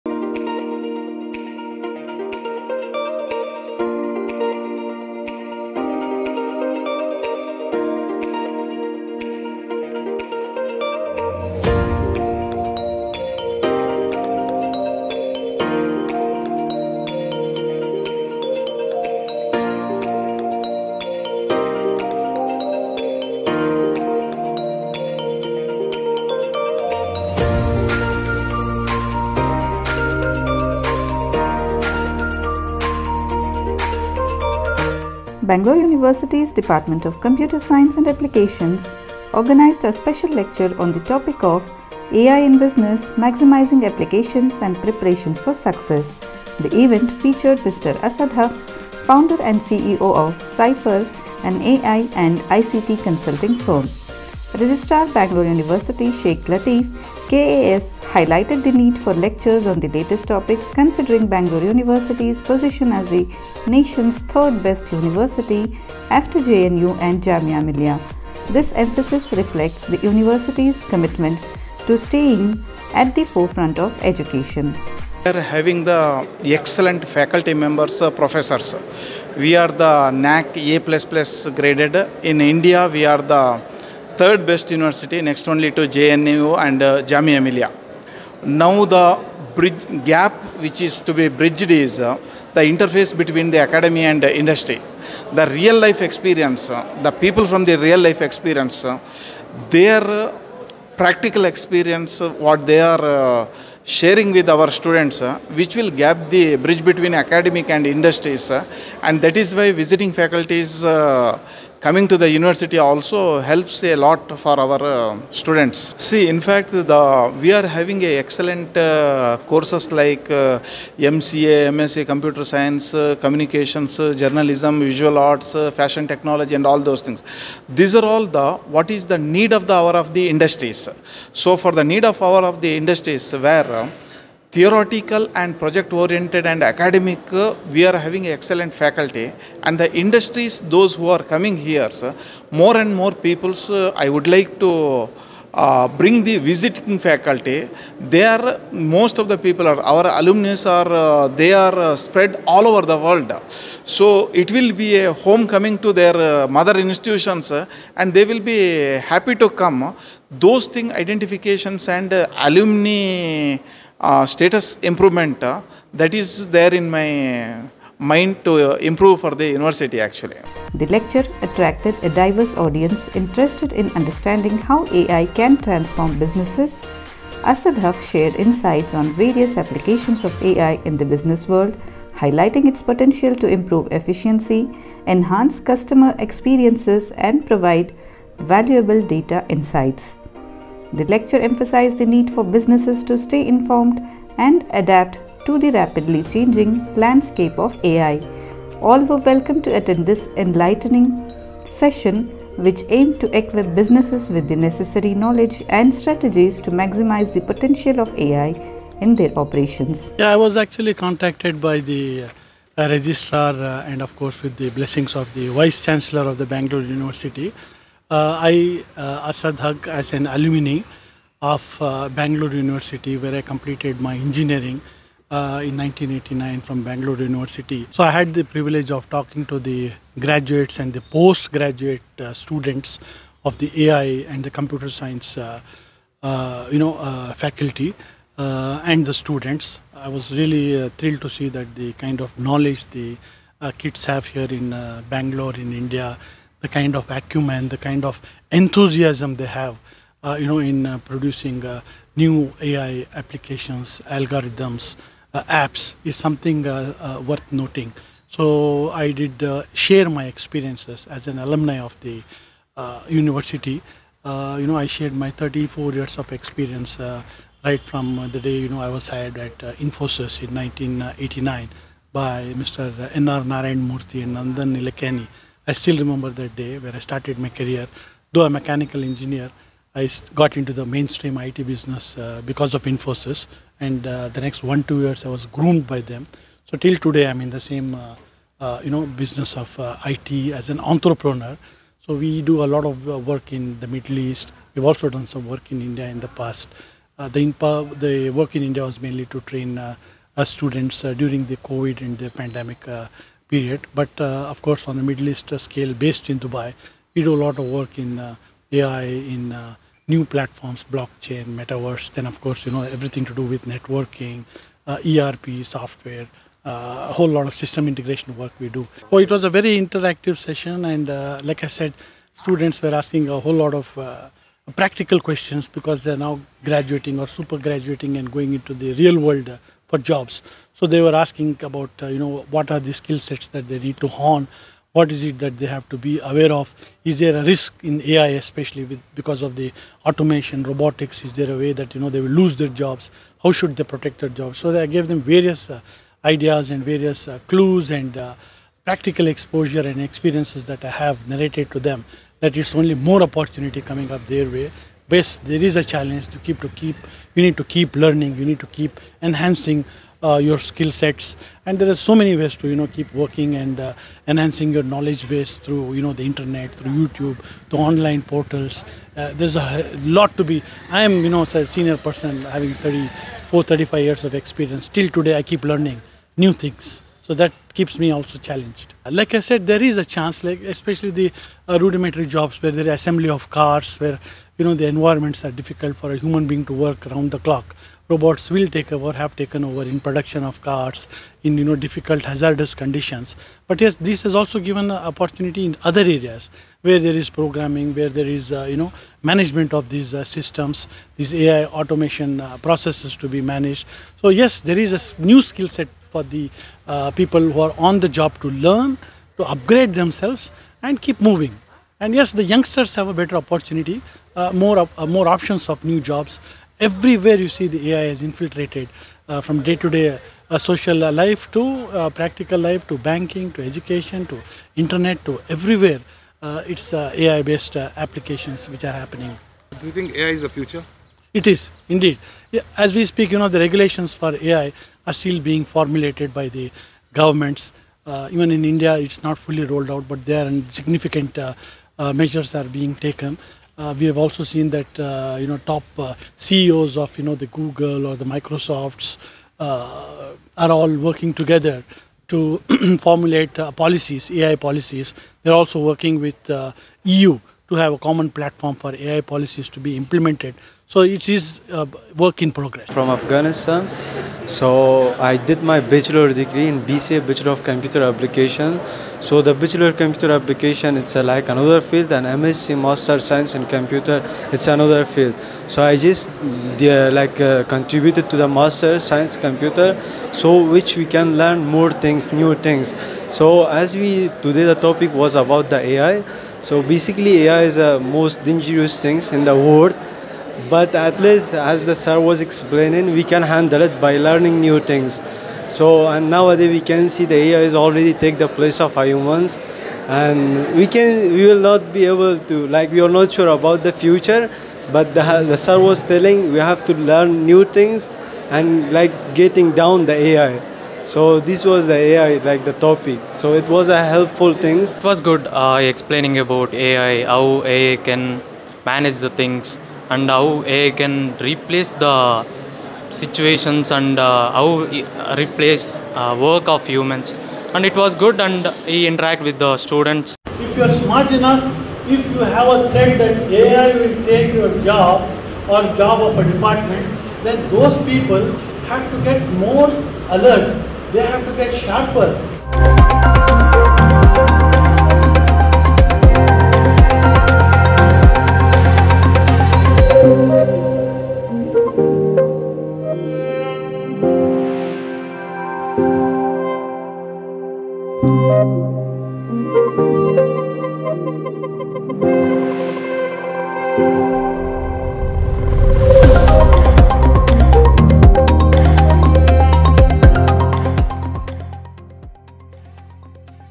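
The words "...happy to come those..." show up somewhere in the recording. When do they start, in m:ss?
2:39.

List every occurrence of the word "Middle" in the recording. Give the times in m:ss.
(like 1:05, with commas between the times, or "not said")
4:53, 5:05.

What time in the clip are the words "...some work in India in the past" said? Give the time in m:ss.
4:55.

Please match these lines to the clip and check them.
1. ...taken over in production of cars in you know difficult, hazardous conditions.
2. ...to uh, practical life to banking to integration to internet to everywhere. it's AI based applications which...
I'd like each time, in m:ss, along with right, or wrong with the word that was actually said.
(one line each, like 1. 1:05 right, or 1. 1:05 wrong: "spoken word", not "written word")
1. 6:29 right
2. 7:01 wrong: "education", not "integration".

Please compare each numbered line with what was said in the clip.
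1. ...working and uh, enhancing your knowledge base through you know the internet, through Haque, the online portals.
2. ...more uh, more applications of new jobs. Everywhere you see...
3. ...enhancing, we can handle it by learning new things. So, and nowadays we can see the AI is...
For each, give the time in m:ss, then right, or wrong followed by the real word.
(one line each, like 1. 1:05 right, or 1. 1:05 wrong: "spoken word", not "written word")
1. 6:03 wrong: "YouTube", not "Haque"
2. 6:54 wrong: "options", not "applications"
3. 8:12 wrong: "explaining", not "enhancing".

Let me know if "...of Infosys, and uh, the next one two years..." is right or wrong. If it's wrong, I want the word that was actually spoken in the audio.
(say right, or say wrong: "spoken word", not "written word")
right.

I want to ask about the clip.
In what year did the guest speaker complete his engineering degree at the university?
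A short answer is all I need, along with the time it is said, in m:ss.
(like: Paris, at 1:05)
1989, at 3:43.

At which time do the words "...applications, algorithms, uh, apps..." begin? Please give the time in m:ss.
4:13.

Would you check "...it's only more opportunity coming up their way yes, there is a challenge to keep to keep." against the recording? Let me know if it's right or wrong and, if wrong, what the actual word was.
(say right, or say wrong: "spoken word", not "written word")
right.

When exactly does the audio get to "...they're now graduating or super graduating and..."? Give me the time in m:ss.
5:26.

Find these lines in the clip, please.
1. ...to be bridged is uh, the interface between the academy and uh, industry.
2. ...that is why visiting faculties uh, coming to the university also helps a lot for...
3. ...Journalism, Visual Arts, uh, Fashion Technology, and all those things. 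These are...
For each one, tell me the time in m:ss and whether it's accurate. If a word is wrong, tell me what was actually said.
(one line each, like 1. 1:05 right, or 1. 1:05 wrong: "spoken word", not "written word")
1. 1:31 right
2. 1:49 right
3. 2:04 right.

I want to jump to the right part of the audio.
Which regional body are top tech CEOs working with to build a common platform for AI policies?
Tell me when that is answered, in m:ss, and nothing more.
7:37.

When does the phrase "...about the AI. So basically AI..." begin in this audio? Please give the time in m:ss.
8:05.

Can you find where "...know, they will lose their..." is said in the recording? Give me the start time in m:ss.
5:42.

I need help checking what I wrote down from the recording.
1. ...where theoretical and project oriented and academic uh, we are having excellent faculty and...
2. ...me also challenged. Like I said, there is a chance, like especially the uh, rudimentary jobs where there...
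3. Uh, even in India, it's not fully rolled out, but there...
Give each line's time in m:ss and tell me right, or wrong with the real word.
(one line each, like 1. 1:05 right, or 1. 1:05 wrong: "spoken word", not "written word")
1. 2:13 right
2. 6:17 right
3. 7:18 right.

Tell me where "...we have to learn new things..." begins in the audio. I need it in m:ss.
8:26.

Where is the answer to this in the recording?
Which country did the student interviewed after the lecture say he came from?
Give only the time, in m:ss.
7:43.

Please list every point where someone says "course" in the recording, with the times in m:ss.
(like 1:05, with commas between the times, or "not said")
1:59, 3:34, 5:04, 5:12.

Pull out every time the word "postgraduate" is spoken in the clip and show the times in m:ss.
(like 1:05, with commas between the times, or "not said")
3:50.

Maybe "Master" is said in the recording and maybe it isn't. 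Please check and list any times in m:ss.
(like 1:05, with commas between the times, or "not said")
7:52, 7:58.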